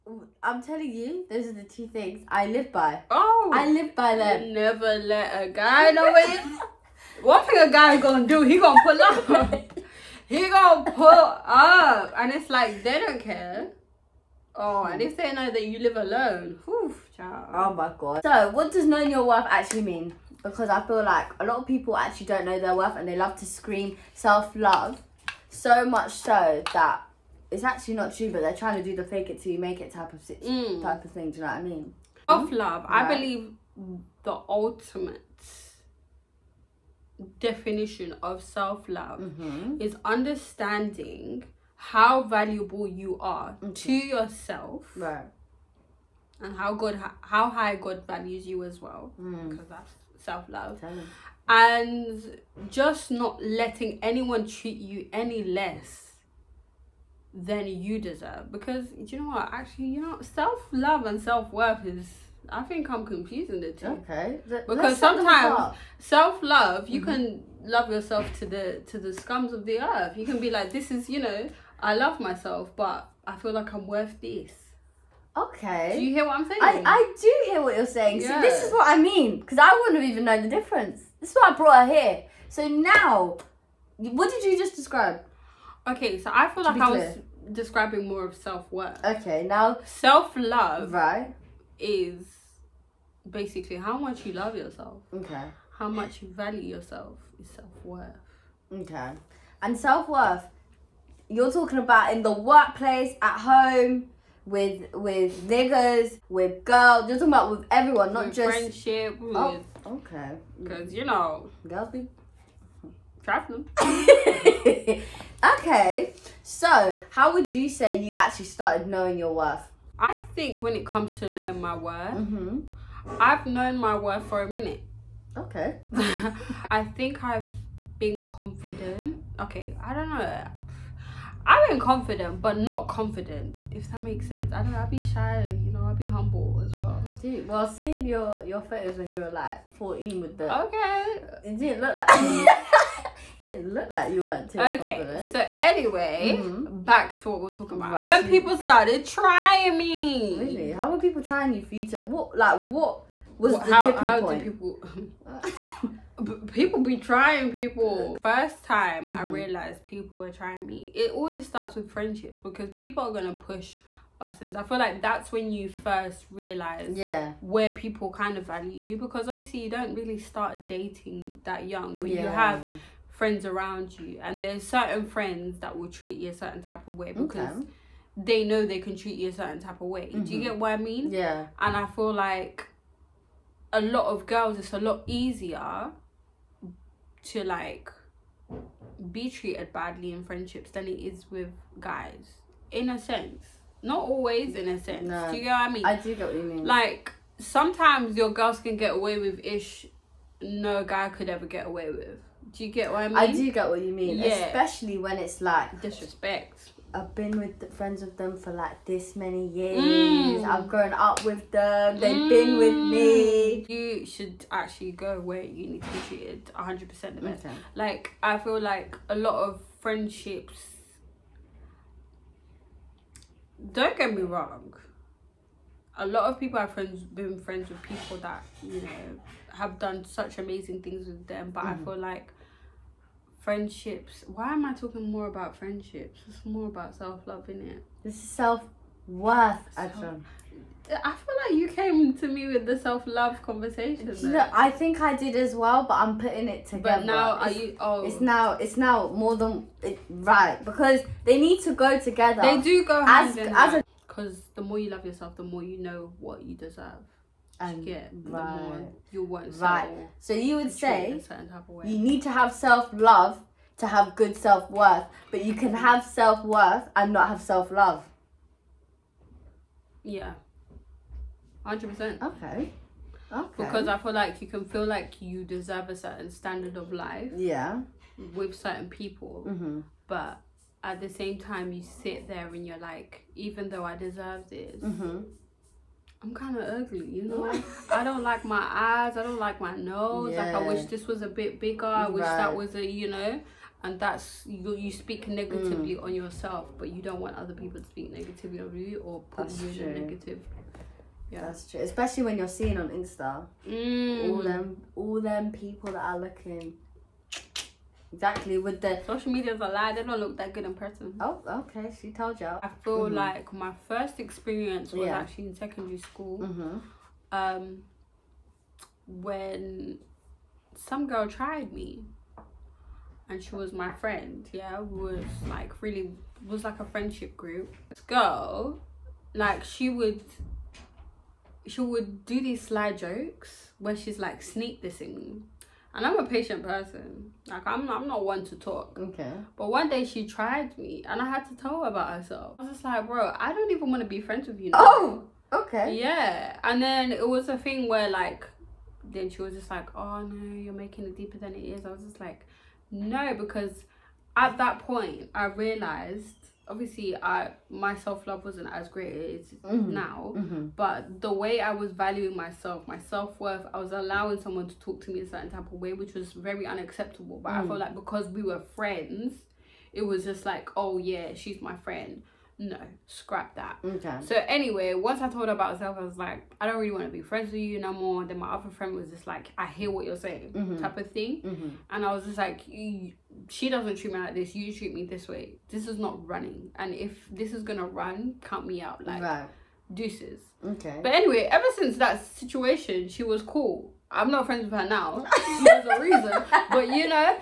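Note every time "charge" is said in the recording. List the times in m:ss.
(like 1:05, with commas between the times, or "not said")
not said.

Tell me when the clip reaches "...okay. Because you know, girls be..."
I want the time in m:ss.
1:50.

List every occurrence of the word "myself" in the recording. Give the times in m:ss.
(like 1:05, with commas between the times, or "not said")
1:12, 6:02, 6:15.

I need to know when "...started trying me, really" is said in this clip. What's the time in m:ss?
2:28.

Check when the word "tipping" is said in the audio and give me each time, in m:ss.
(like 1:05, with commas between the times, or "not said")
2:33.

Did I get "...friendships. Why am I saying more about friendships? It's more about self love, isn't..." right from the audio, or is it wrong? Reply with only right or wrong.
wrong.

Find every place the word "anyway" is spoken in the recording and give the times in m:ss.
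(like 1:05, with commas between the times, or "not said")
2:25, 6:14, 6:31.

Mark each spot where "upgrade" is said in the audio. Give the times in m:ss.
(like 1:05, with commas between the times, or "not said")
not said.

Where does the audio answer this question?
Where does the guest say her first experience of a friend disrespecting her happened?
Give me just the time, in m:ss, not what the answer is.
5:15.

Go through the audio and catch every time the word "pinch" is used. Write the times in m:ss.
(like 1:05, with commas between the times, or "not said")
not said.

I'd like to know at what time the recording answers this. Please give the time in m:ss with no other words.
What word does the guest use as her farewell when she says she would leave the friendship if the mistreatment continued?
6:29.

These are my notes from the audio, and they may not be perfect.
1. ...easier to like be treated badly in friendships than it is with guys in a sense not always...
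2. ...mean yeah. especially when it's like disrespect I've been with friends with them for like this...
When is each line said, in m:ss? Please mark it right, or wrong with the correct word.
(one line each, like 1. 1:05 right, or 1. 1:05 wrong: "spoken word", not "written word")
1. 3:05 right
2. 3:23 right.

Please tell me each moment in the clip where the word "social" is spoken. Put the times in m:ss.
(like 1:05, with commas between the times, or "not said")
5:09.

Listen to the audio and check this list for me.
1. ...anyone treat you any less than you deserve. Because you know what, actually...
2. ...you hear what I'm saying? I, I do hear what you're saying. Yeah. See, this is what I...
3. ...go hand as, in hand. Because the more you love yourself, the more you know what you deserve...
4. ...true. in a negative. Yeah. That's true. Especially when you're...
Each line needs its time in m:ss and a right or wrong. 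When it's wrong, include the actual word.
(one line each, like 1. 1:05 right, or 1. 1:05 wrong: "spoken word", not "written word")
1. 0:54 right
2. 1:16 right
3. 4:12 right
4. 4:59 right.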